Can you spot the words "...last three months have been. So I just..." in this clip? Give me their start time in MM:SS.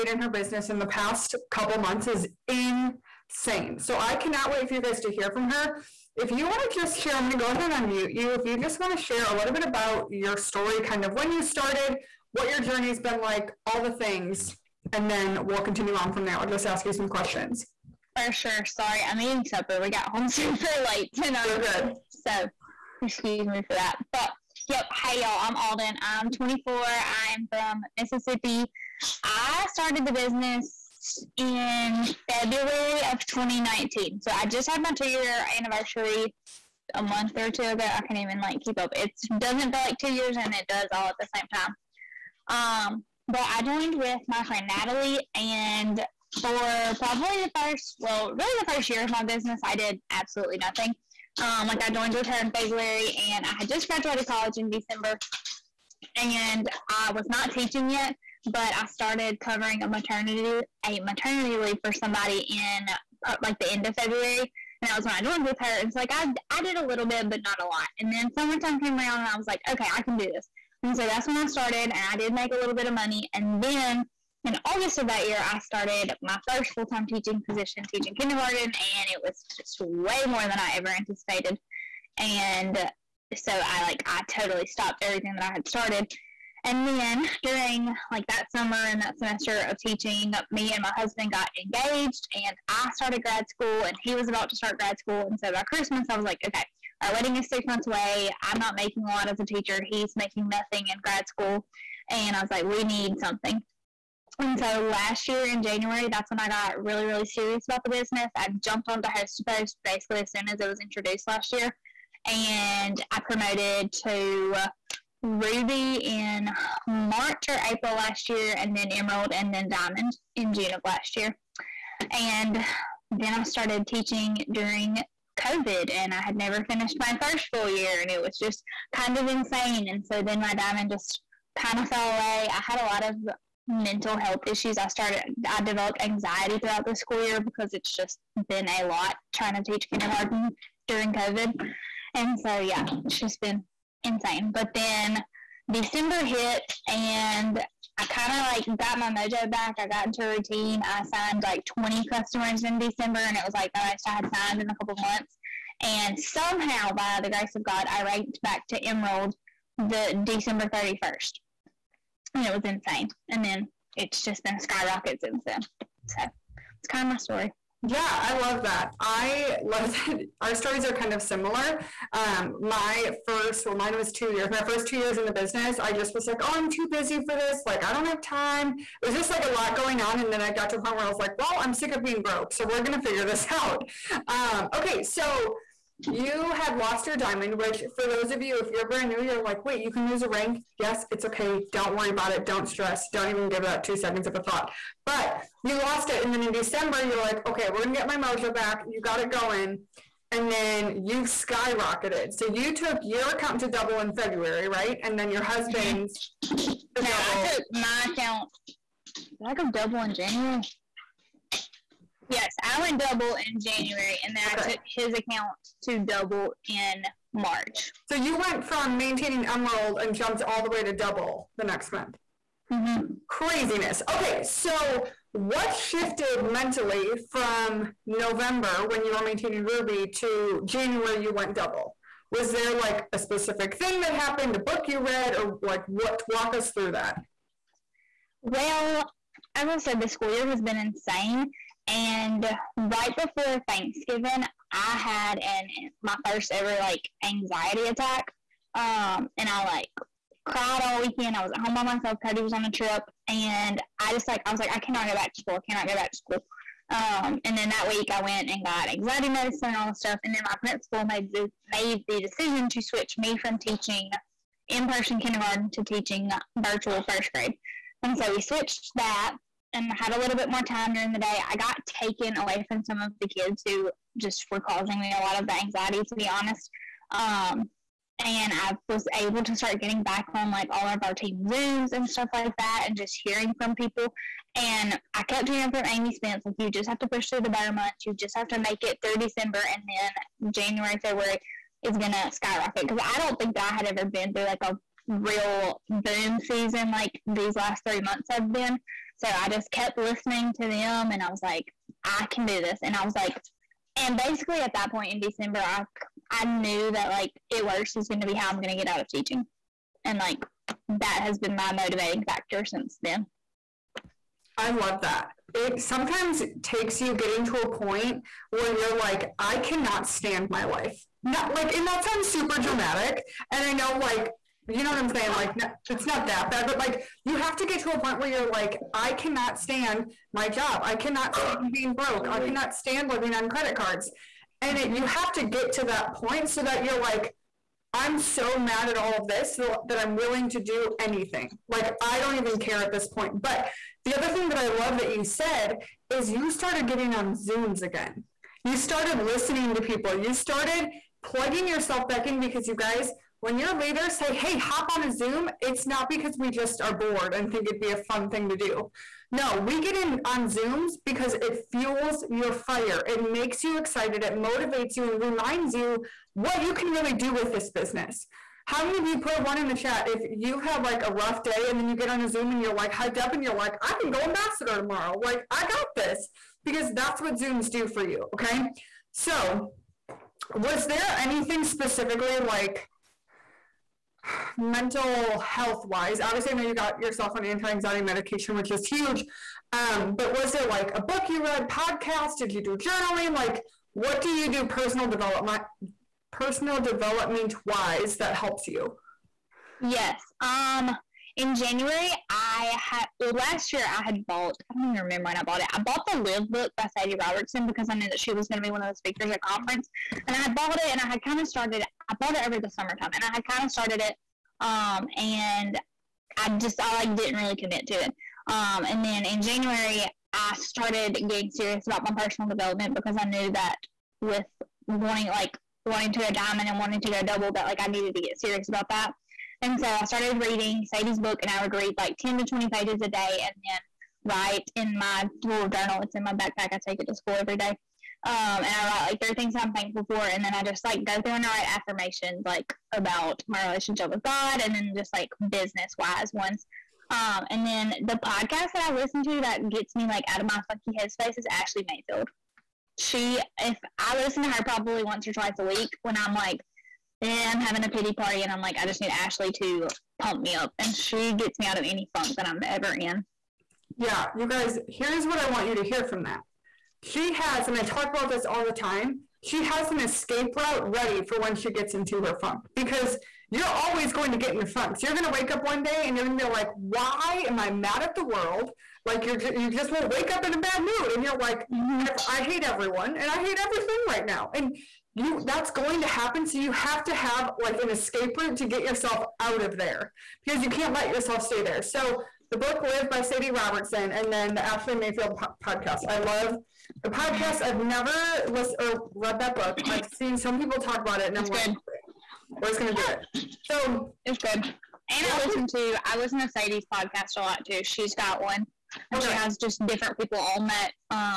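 04:57.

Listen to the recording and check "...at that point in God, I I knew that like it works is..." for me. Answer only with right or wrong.
wrong.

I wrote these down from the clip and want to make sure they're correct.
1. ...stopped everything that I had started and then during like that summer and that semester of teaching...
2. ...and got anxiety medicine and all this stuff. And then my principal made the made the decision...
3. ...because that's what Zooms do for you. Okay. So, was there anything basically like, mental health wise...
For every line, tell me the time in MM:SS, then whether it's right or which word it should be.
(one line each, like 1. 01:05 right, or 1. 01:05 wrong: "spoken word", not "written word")
1. 01:24 right
2. 04:18 right
3. 06:16 wrong: "specifically", not "basically".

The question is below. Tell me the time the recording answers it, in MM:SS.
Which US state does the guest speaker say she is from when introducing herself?
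00:27.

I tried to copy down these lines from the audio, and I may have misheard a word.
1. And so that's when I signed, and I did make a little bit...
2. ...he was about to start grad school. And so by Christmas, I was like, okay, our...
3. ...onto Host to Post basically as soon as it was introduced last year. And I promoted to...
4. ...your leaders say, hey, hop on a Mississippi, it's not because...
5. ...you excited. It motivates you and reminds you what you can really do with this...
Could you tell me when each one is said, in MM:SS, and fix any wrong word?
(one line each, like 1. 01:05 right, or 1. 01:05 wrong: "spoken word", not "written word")
1. 01:10 wrong: "started", not "signed"
2. 01:34 right
3. 01:48 right
4. 05:53 wrong: "Zoom", not "Mississippi"
5. 06:03 right.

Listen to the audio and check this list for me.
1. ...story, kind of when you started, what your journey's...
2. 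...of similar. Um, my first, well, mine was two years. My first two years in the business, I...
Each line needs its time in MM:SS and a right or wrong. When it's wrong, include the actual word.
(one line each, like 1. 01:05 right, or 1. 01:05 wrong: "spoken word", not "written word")
1. 00:10 right
2. 02:51 right.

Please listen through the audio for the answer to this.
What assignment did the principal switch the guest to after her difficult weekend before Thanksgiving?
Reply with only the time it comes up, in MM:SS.
04:26.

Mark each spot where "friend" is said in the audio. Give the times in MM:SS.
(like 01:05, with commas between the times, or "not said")
00:44.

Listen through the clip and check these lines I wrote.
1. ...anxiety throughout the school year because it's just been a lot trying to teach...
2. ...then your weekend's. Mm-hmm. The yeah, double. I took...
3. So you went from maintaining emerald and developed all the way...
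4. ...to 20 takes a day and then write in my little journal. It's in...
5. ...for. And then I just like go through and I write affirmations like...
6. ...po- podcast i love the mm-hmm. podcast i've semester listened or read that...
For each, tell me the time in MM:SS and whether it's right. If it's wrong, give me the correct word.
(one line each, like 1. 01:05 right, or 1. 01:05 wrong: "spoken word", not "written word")
1. 02:16 right
2. 03:25 wrong: "husband", not "weekend"
3. 03:38 wrong: "jumped", not "developed"
4. 07:12 wrong: "pages", not "takes"
5. 07:20 right
6. 08:15 wrong: "never", not "semester".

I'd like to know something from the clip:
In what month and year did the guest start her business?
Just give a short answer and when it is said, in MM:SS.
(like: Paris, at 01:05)
February 2019, at 00:32.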